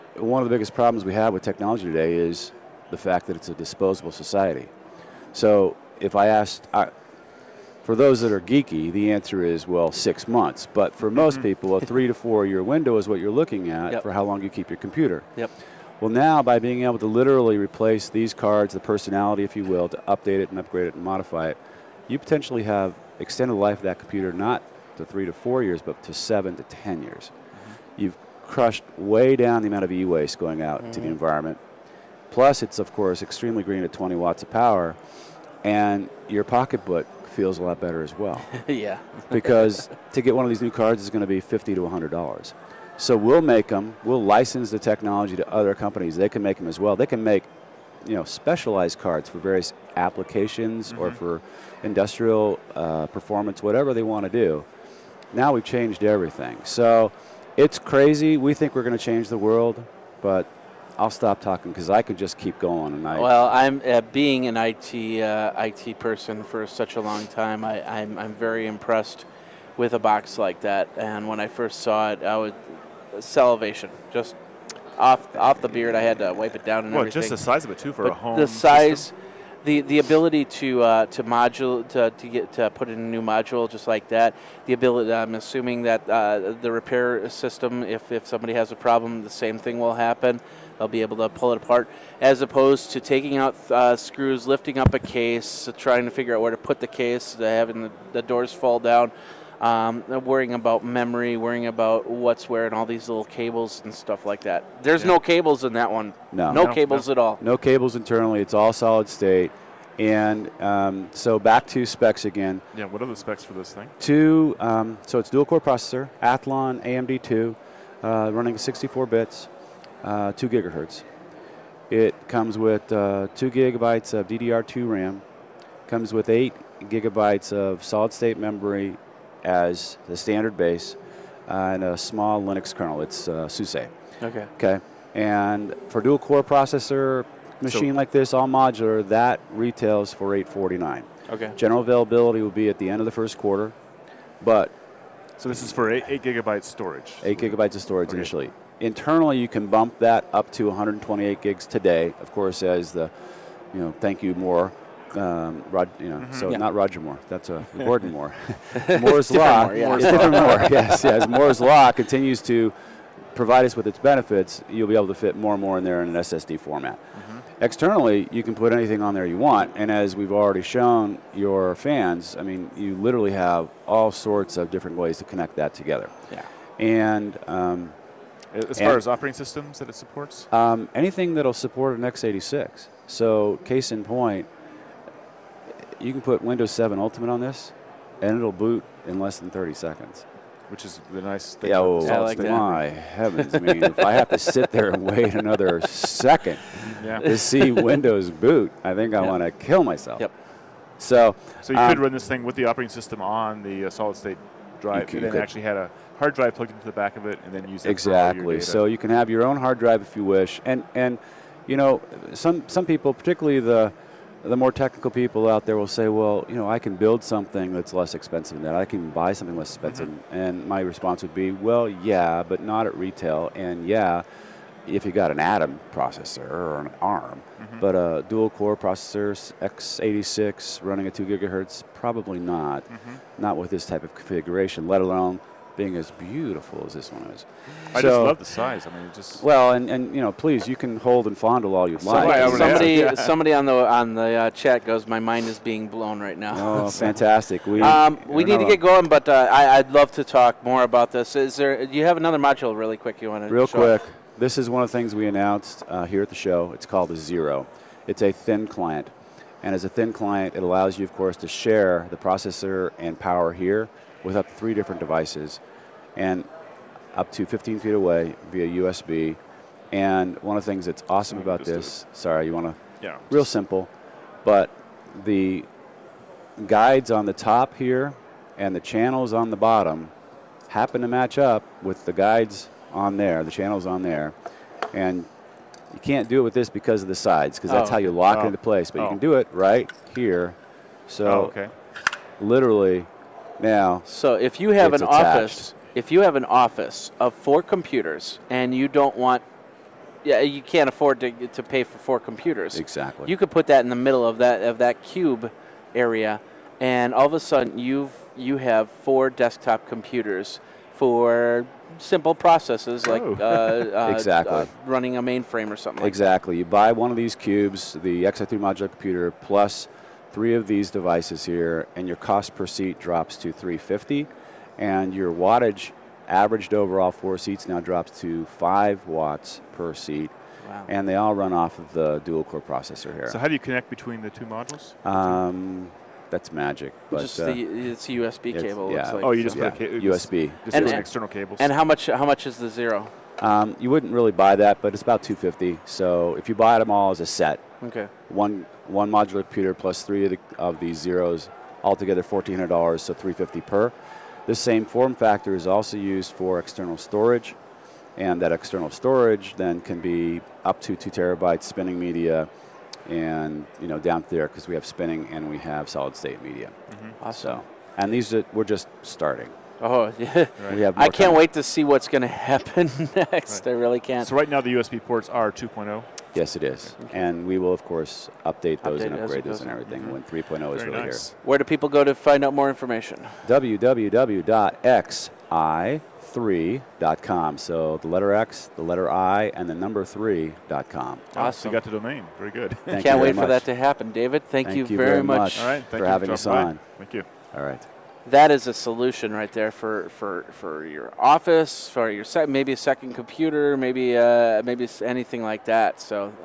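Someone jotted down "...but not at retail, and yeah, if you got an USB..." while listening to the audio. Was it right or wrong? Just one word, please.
wrong.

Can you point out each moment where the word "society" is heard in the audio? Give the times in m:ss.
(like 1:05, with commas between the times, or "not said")
0:04.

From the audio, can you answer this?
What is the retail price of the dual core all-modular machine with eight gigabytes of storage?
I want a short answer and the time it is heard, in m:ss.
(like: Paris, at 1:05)
849, at 2:20.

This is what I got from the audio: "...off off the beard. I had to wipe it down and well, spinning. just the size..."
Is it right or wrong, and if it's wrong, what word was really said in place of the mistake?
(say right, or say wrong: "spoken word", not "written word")
wrong: "everything", not "spinning".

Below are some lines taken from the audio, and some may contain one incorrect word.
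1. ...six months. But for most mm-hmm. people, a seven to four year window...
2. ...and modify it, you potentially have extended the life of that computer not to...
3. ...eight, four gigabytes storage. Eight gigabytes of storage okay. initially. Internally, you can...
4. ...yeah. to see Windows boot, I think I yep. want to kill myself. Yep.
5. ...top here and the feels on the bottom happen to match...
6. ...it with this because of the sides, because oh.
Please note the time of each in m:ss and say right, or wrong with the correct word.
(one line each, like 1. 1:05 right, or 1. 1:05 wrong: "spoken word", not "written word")
1. 0:09 wrong: "three", not "seven"
2. 0:20 right
3. 2:25 wrong: "eight", not "four"
4. 3:17 right
5. 4:37 wrong: "channels", not "feels"
6. 4:46 right.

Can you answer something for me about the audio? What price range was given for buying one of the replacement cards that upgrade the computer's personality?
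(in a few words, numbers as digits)
50 to 100 dollars.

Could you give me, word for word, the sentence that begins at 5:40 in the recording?
Just, just and, an external cable.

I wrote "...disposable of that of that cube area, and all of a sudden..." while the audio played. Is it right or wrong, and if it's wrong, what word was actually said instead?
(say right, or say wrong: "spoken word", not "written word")
wrong: "middle", not "disposable".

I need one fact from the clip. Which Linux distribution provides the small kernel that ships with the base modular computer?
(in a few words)
SUSE.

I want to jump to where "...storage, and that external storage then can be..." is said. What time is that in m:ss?
5:56.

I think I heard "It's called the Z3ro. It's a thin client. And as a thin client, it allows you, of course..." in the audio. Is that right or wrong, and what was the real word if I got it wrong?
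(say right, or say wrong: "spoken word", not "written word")
right.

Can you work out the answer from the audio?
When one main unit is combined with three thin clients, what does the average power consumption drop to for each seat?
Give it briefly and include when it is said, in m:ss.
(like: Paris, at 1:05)
5 watts per seat, at 5:28.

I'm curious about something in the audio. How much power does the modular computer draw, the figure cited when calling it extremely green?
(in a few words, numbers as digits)
20 watts.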